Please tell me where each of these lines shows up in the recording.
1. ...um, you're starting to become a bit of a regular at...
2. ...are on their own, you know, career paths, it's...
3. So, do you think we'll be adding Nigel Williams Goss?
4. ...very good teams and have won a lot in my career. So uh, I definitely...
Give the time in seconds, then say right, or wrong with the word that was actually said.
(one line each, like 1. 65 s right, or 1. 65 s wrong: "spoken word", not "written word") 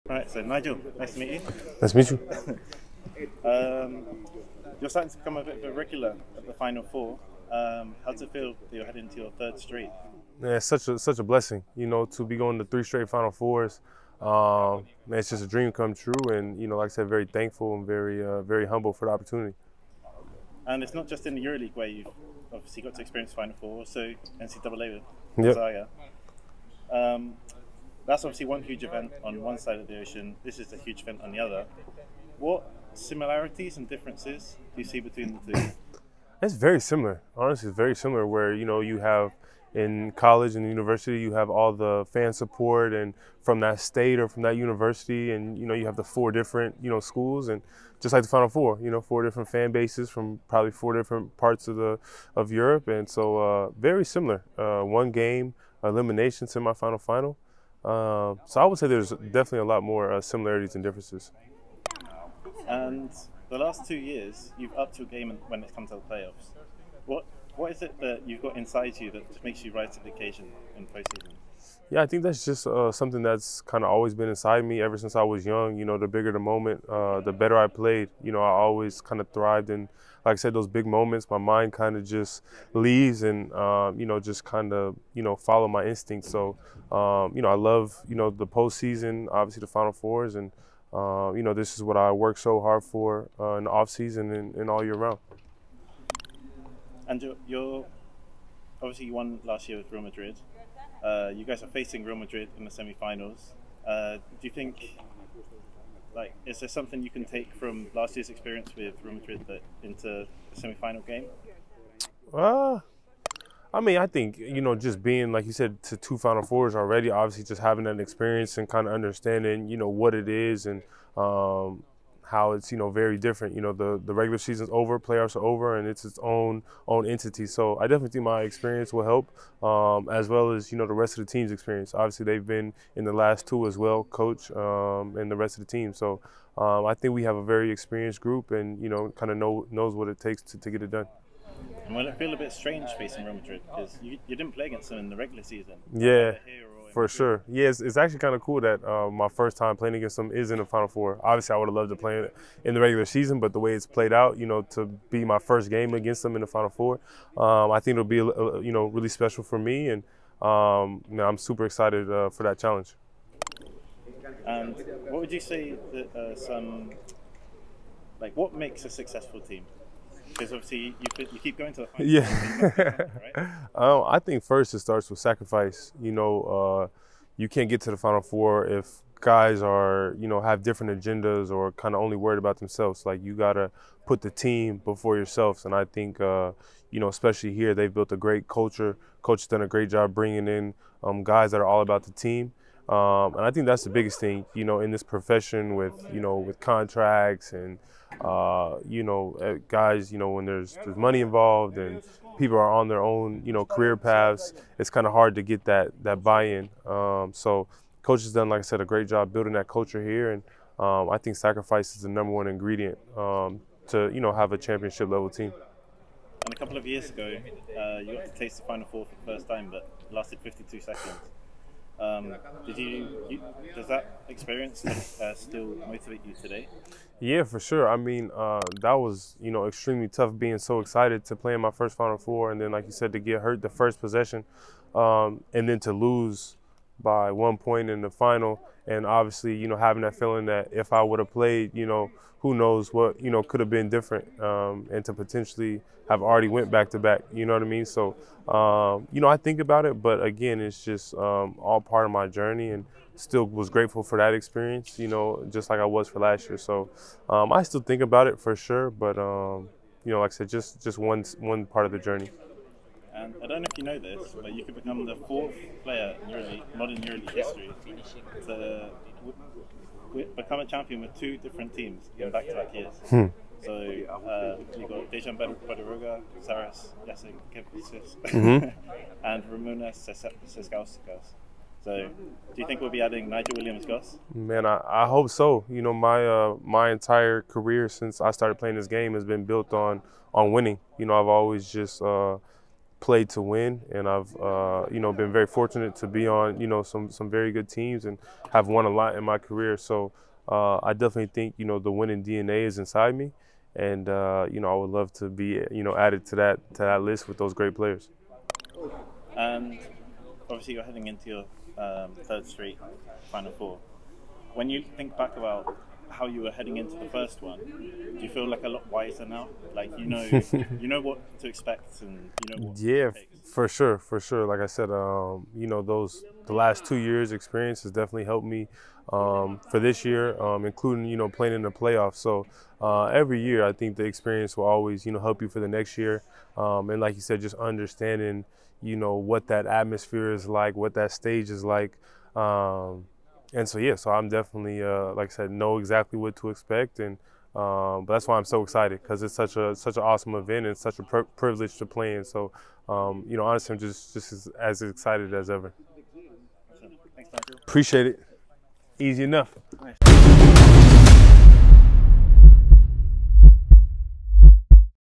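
1. 3 s right
2. 202 s right
3. 281 s right
4. 297 s right.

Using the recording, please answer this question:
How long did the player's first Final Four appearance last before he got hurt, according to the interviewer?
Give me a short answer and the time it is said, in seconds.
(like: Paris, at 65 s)
52 seconds, at 220 s.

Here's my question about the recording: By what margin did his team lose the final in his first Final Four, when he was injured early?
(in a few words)
1 point.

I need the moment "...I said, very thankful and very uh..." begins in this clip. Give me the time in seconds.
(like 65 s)
16 s.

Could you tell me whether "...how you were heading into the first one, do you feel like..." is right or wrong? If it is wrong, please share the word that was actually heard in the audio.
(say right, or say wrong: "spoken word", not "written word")
right.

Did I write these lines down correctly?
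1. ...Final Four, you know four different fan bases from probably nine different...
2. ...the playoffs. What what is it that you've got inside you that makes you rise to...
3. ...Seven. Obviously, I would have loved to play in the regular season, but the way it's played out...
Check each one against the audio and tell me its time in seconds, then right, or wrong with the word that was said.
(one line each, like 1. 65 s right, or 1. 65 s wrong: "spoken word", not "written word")
1. 48 s wrong: "four", not "nine"
2. 65 s right
3. 150 s wrong: "Four", not "Seven".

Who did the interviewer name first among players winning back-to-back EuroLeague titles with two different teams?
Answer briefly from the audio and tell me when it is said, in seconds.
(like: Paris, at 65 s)
Dejan Bodiroga, at 275 s.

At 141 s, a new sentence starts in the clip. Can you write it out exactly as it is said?
And will it feel a bit strange facing Real Madrid because you, you didn't play against them in the regular season?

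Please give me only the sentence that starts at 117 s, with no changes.
Obviously, just having that experience and kind of understanding, you know, what it is and um, how it's you know very different.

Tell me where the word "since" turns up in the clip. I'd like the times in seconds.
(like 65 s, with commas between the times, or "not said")
74 s, 287 s.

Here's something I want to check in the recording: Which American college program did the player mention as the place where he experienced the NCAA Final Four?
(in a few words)
Gonzaga.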